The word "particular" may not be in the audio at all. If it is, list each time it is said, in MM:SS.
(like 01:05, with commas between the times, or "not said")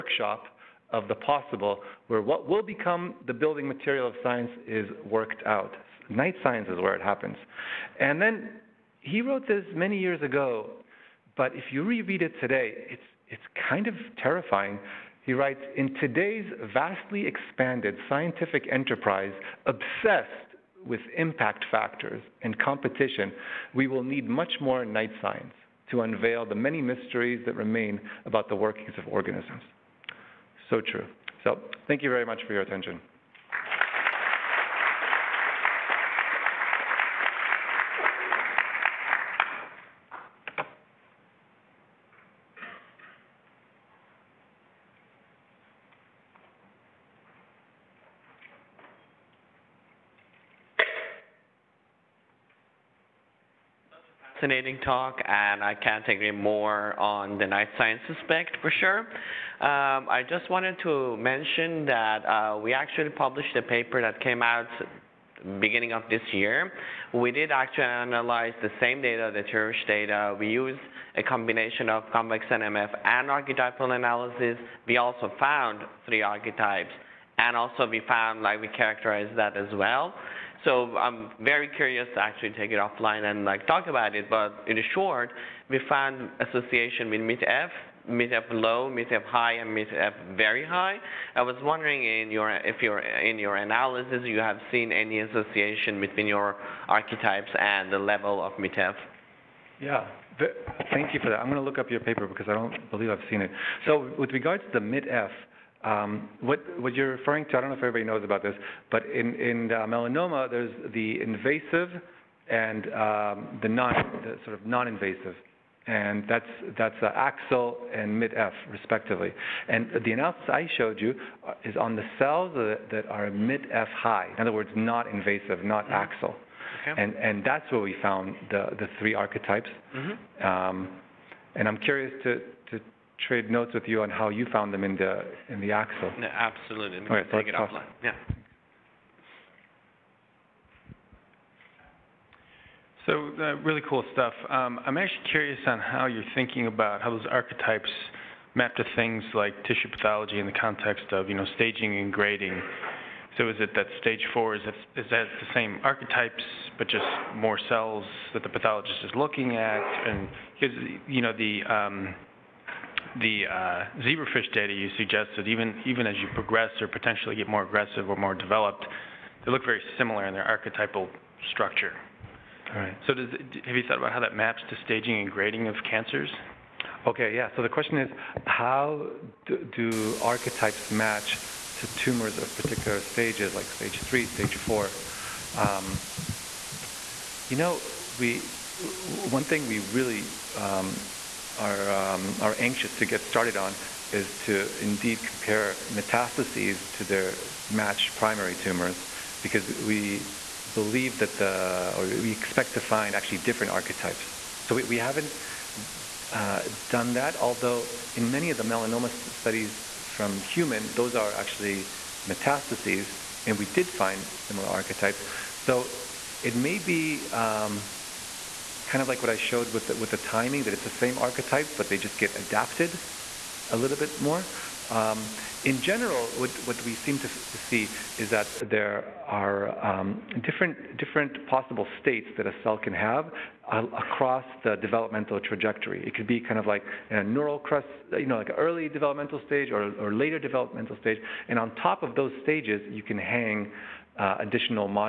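03:02.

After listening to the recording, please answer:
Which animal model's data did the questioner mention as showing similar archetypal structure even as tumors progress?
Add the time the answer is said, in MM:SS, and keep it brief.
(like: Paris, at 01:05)
Zebrafish, at 02:44.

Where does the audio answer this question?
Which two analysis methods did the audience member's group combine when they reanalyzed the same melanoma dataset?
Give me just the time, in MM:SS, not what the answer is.
01:12.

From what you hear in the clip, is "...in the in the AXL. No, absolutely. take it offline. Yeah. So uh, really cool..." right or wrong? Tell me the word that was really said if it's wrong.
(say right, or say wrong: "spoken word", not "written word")
right.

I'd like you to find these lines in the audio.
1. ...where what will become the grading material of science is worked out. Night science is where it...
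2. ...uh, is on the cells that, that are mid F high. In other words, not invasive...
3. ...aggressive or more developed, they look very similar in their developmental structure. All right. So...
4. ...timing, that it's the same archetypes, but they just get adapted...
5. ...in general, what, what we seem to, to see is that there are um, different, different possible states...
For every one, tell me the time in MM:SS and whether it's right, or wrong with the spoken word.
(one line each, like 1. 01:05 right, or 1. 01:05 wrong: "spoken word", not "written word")
1. 00:02 wrong: "building", not "grading"
2. 02:01 right
3. 02:47 wrong: "archetypal", not "developmental"
4. 03:40 right
5. 03:45 right.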